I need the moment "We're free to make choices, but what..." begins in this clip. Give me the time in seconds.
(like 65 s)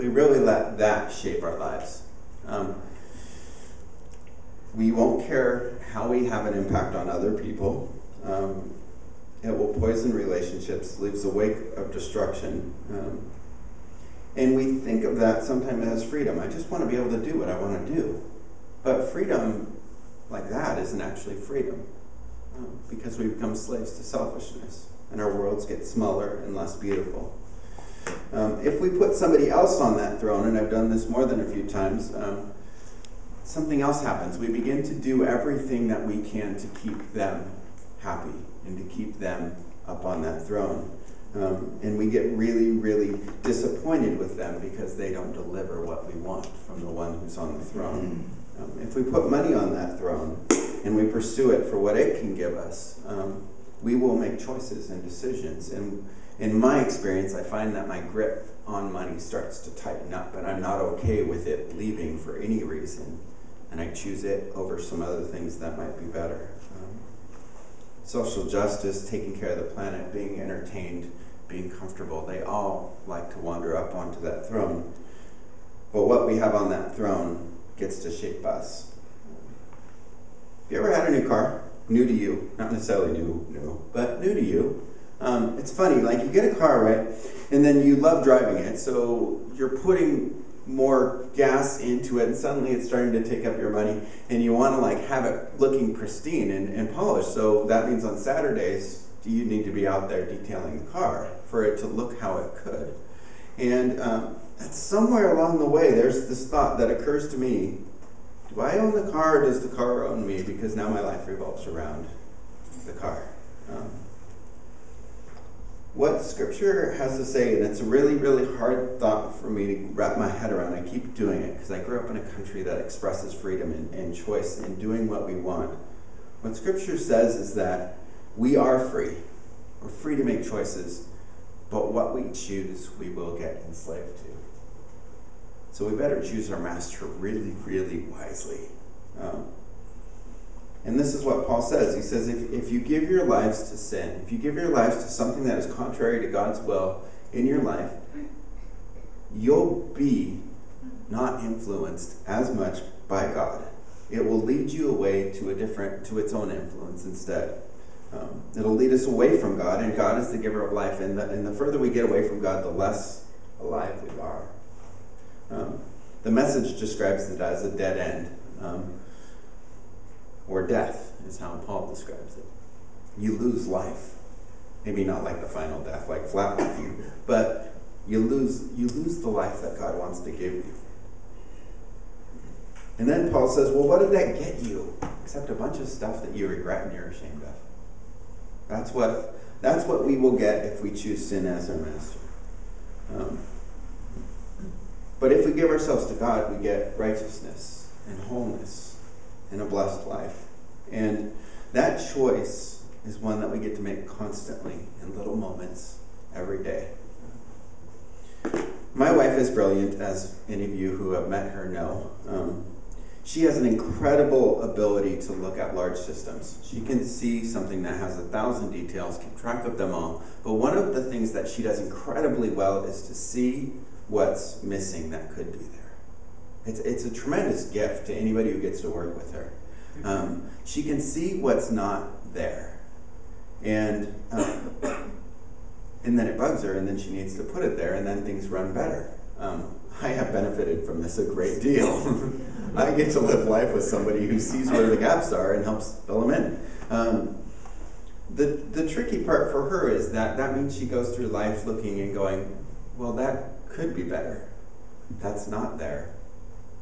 129 s.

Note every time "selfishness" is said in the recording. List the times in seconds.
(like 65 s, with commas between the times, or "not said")
24 s.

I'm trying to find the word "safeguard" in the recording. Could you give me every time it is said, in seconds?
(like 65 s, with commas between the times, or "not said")
not said.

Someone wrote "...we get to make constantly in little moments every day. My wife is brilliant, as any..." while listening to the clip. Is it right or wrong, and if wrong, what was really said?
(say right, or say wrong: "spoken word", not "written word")
right.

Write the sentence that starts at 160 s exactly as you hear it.
And the, and the further we get away from God, the less alive we are.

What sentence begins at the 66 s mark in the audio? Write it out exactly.
Um, social justice, taking care of the planet, being entertained, being comfortable, they all like to wander up onto that throne.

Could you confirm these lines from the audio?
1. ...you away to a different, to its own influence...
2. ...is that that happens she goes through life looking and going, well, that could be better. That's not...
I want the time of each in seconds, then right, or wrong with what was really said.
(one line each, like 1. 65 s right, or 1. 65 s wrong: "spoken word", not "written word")
1. 154 s right
2. 249 s wrong: "means", not "happens".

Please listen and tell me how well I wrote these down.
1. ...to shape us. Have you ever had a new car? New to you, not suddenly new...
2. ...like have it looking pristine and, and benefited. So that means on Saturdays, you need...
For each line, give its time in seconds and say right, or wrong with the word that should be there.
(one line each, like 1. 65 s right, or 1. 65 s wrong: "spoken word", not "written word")
1. 78 s wrong: "necessarily", not "suddenly"
2. 94 s wrong: "polished", not "benefited".